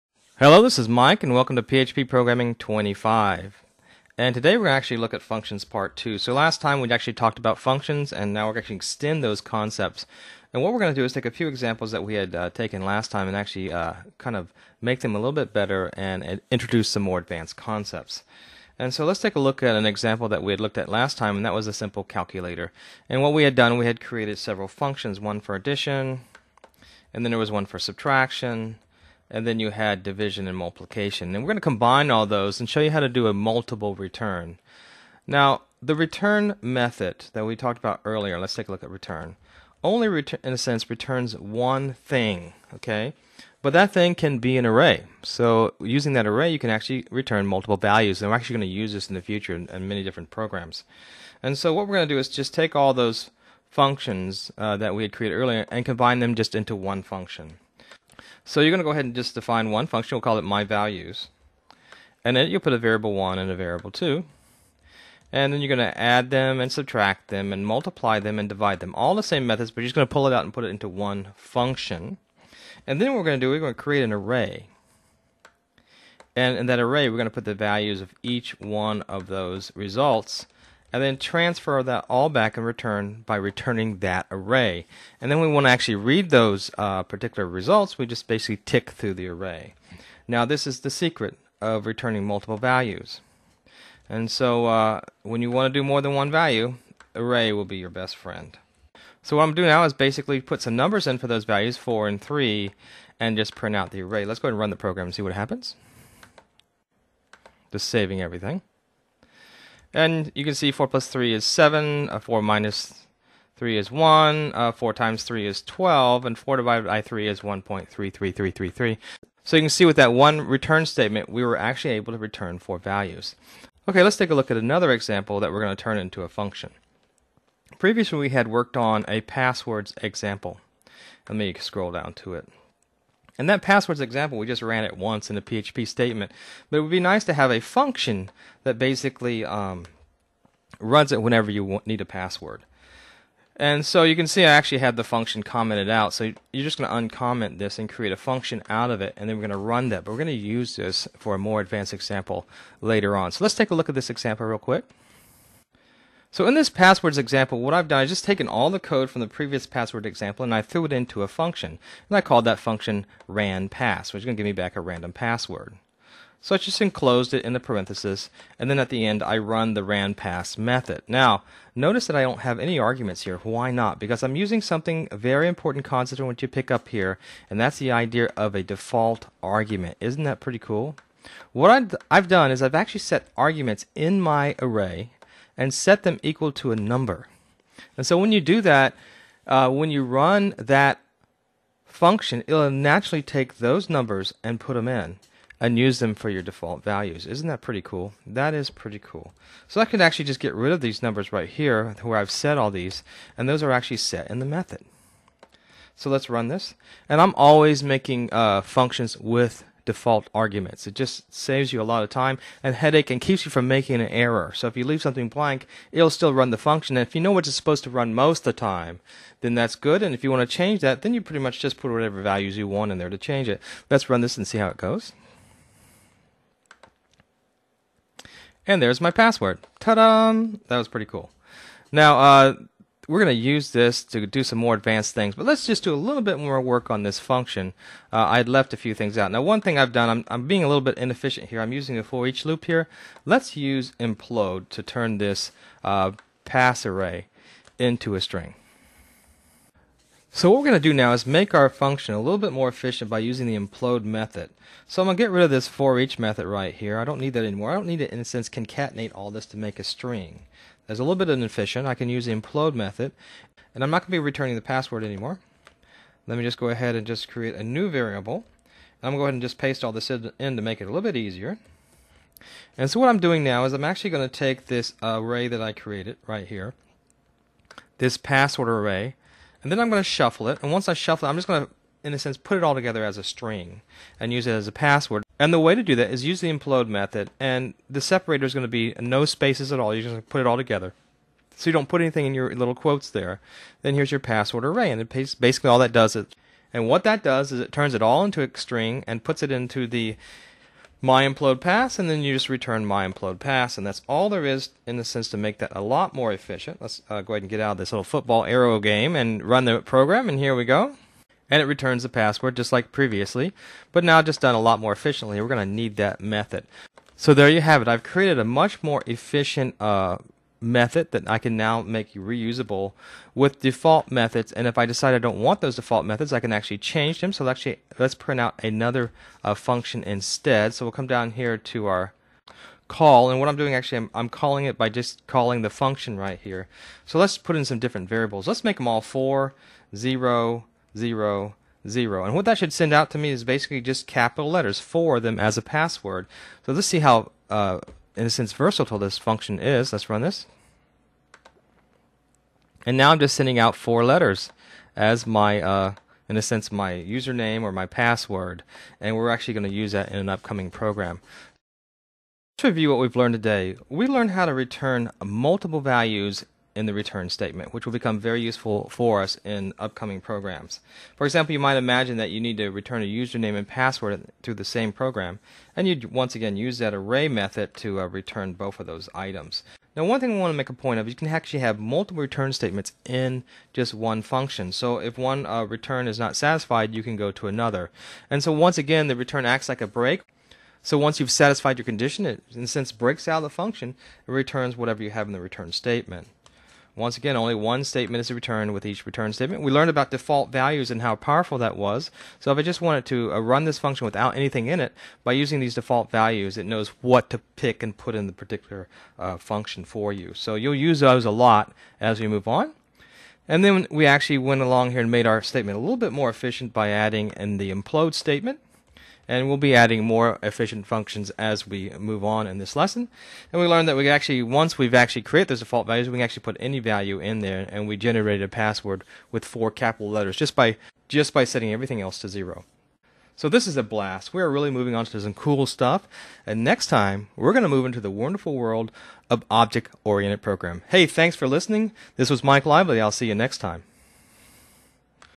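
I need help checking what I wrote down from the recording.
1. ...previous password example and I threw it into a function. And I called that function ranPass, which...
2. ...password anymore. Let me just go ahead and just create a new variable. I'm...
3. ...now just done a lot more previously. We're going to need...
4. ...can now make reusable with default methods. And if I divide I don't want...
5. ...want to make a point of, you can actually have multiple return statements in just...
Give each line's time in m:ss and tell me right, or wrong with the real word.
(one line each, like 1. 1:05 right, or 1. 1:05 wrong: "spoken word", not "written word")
1. 2:39 right
2. 4:24 right
3. 5:14 wrong: "efficiently", not "previously"
4. 5:21 wrong: "decide", not "divide"
5. 6:20 right.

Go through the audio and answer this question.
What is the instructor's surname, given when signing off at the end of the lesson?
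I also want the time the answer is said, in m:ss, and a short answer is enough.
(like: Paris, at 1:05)
Lively, at 7:22.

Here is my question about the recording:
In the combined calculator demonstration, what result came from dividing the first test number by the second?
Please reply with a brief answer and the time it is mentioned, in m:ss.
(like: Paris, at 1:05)
1.33333, at 1:57.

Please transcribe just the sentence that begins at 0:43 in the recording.
But that thing can be an array.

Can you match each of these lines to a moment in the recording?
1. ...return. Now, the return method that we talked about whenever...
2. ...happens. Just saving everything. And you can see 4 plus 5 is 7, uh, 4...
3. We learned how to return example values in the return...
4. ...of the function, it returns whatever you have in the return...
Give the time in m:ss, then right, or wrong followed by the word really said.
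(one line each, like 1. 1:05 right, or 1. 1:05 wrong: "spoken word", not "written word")
1. 0:33 wrong: "earlier", not "whenever"
2. 1:45 wrong: "3", not "5"
3. 6:03 wrong: "multiple", not "example"
4. 6:33 right.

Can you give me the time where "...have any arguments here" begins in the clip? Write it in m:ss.
2:52.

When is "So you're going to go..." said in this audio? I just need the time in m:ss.
0:58.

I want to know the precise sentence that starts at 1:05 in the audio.
And then you're going to add them and subtract them and multiply them and divide them.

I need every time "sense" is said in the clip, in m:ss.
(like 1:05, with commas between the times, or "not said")
0:40, 4:18, 4:42, 5:05, 5:48, 5:56.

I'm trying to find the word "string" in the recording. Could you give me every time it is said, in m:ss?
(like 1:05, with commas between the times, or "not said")
4:08, 4:19, 4:43, 4:58.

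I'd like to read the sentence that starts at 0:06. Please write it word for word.
So last time we actually talked about functions, and now we're going to extend those concepts.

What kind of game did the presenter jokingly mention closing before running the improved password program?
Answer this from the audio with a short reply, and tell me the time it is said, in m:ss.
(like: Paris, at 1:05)
football arrow game, at 5:08.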